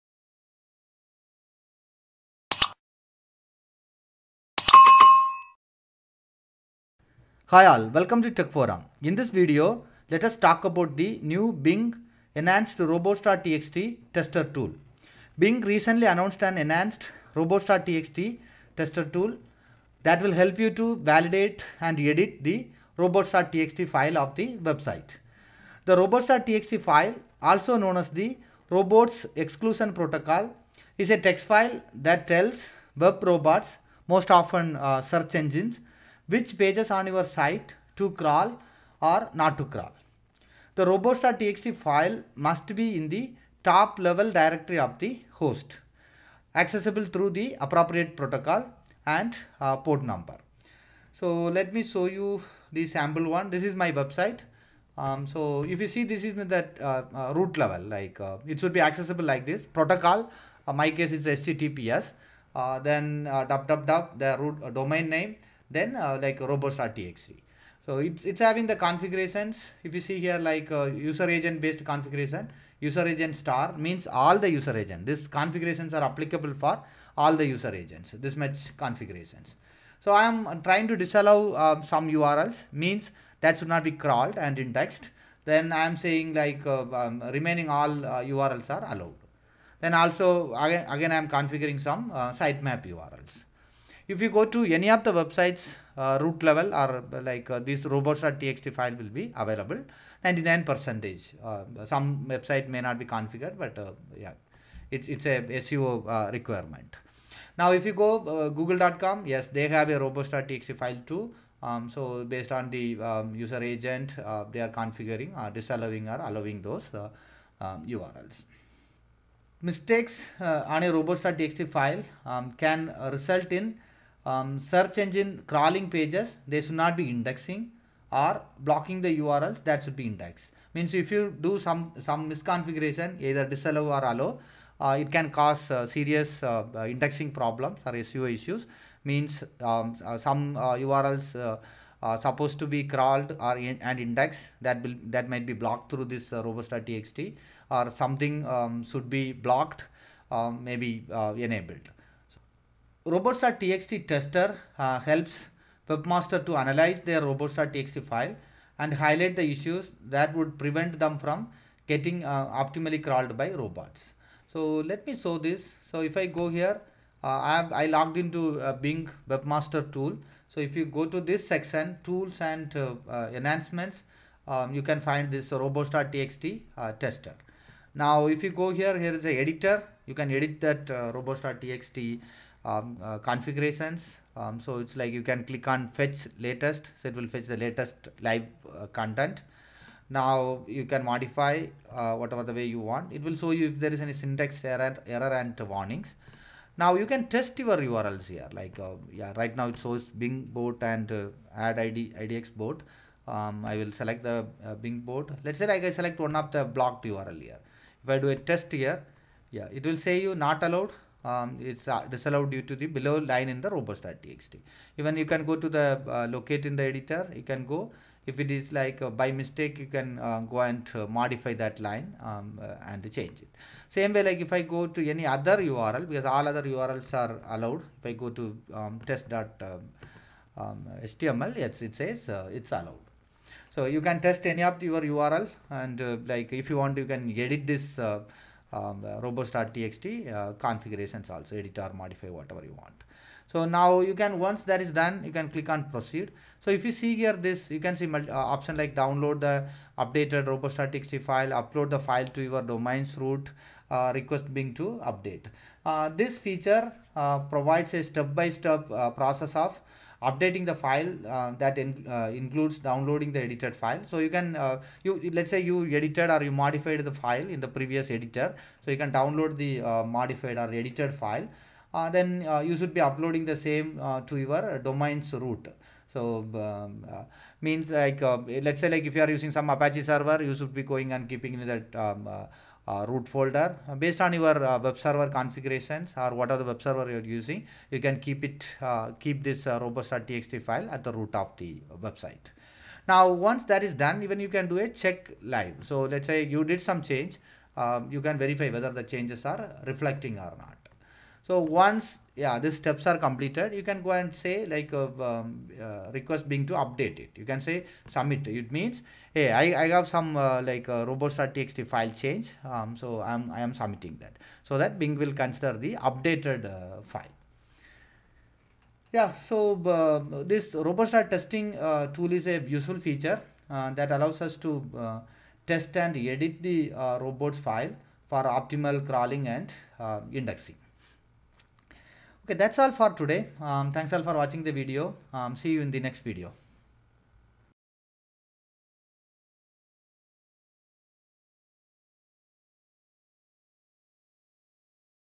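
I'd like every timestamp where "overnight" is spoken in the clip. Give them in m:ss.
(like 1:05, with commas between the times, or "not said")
not said.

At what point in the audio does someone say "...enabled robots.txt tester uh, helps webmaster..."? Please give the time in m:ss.
2:31.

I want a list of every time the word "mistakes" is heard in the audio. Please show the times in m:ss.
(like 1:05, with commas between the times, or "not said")
1:59, 3:39.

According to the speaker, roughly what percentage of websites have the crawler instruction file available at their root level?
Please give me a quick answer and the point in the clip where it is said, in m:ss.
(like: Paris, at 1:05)
99 percent, at 1:40.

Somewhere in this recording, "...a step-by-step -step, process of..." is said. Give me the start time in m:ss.
4:17.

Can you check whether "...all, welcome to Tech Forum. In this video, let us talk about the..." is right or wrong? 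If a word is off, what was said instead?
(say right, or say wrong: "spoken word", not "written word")
right.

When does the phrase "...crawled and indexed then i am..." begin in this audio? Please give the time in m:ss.
1:24.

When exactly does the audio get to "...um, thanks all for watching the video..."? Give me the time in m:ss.
5:33.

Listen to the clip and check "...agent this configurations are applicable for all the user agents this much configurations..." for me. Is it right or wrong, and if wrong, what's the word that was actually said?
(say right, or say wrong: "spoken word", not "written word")
right.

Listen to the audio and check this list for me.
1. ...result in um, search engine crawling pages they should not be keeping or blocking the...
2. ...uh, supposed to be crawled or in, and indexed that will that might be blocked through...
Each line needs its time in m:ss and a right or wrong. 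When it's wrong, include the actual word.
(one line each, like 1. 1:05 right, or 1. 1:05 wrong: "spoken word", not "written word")
1. 2:03 wrong: "indexing", not "keeping"
2. 2:22 right.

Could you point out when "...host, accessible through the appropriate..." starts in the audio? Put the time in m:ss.
0:45.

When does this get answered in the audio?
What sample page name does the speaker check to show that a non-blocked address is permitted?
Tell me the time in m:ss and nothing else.
3:49.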